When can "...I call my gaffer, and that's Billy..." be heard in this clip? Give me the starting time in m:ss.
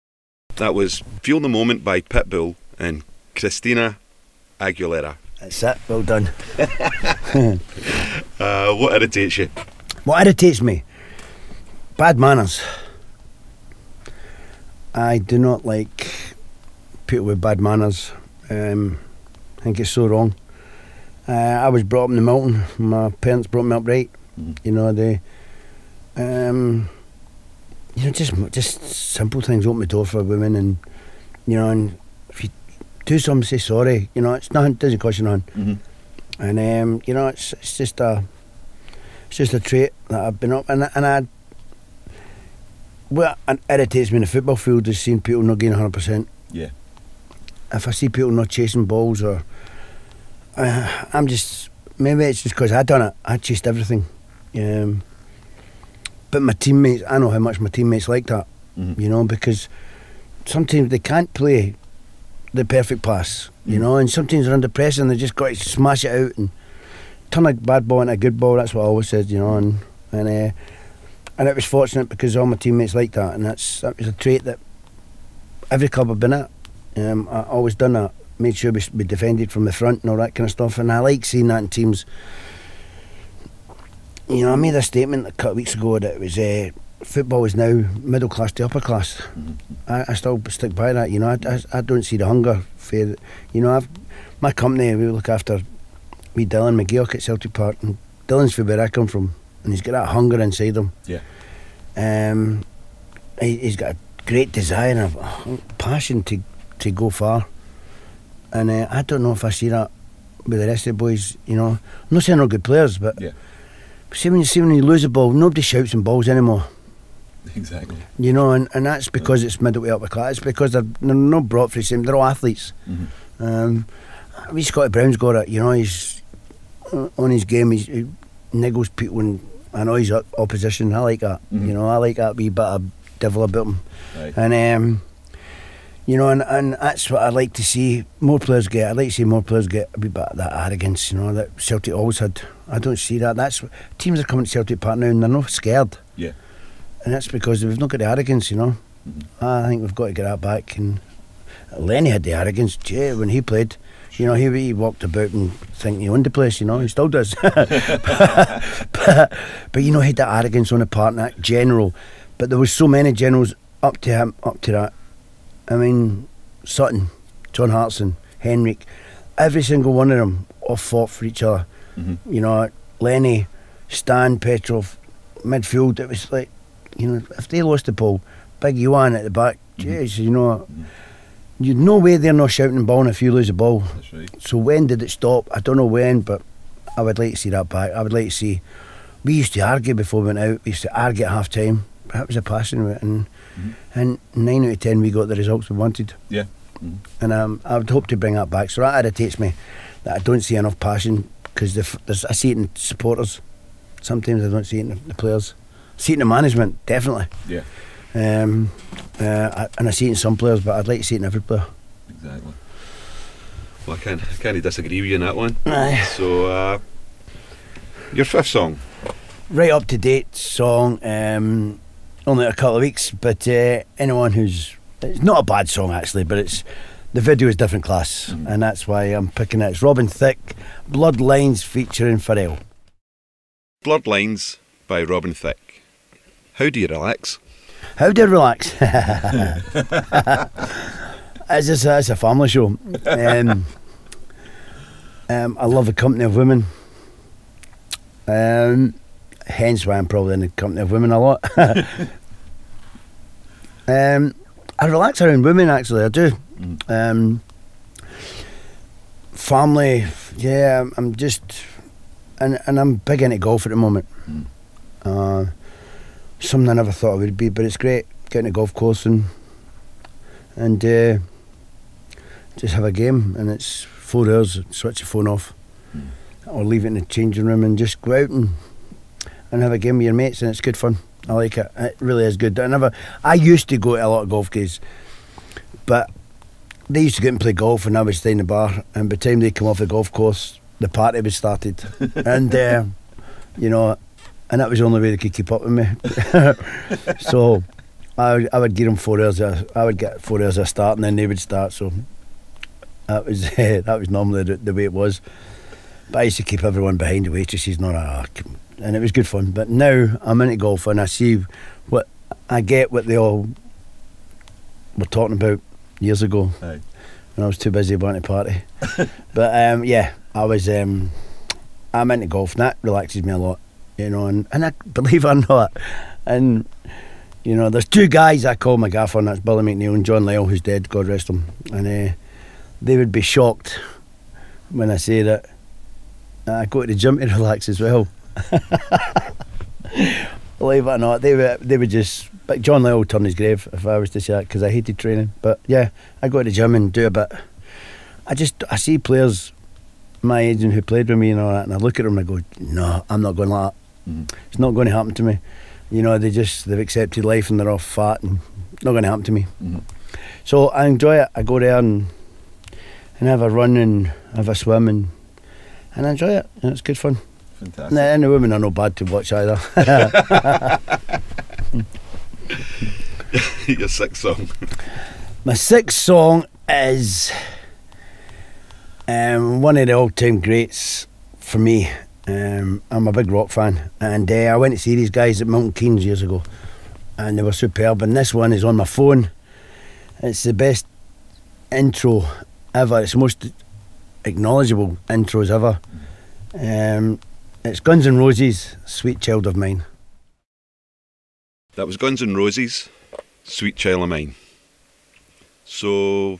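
5:28.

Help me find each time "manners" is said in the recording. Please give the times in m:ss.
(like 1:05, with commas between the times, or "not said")
0:12, 0:17.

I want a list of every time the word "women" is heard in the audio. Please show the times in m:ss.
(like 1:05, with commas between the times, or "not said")
0:30, 4:06, 4:10, 4:15, 6:08.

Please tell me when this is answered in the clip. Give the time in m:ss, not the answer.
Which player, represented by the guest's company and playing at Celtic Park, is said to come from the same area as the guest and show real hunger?
1:36.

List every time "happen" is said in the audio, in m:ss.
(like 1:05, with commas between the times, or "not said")
5:54, 5:59.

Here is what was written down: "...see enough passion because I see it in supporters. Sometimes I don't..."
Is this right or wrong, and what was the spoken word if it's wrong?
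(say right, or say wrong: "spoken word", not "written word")
right.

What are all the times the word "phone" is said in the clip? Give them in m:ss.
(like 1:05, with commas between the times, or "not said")
4:35, 6:28.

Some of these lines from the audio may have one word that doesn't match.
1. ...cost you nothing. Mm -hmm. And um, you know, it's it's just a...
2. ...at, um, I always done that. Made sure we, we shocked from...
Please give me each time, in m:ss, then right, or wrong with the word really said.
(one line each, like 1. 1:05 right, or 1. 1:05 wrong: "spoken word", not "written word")
1. 0:34 right
2. 1:16 wrong: "defended", not "shocked".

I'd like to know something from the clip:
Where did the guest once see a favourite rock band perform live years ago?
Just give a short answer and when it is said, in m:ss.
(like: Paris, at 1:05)
Milton Keynes, at 6:25.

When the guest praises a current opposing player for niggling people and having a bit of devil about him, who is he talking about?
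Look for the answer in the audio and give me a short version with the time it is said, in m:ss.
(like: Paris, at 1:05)
Scotty Brown, at 2:04.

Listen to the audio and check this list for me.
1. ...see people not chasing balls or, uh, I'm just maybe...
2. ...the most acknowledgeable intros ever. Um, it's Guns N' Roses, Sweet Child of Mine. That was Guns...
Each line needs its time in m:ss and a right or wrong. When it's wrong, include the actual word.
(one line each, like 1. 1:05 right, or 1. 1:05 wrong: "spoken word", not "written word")
1. 0:47 right
2. 6:33 right.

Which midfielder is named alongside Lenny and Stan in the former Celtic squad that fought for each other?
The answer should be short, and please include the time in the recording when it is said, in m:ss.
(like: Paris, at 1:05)
Petrov, at 2:54.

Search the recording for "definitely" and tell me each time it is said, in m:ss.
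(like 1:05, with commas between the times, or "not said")
3:26.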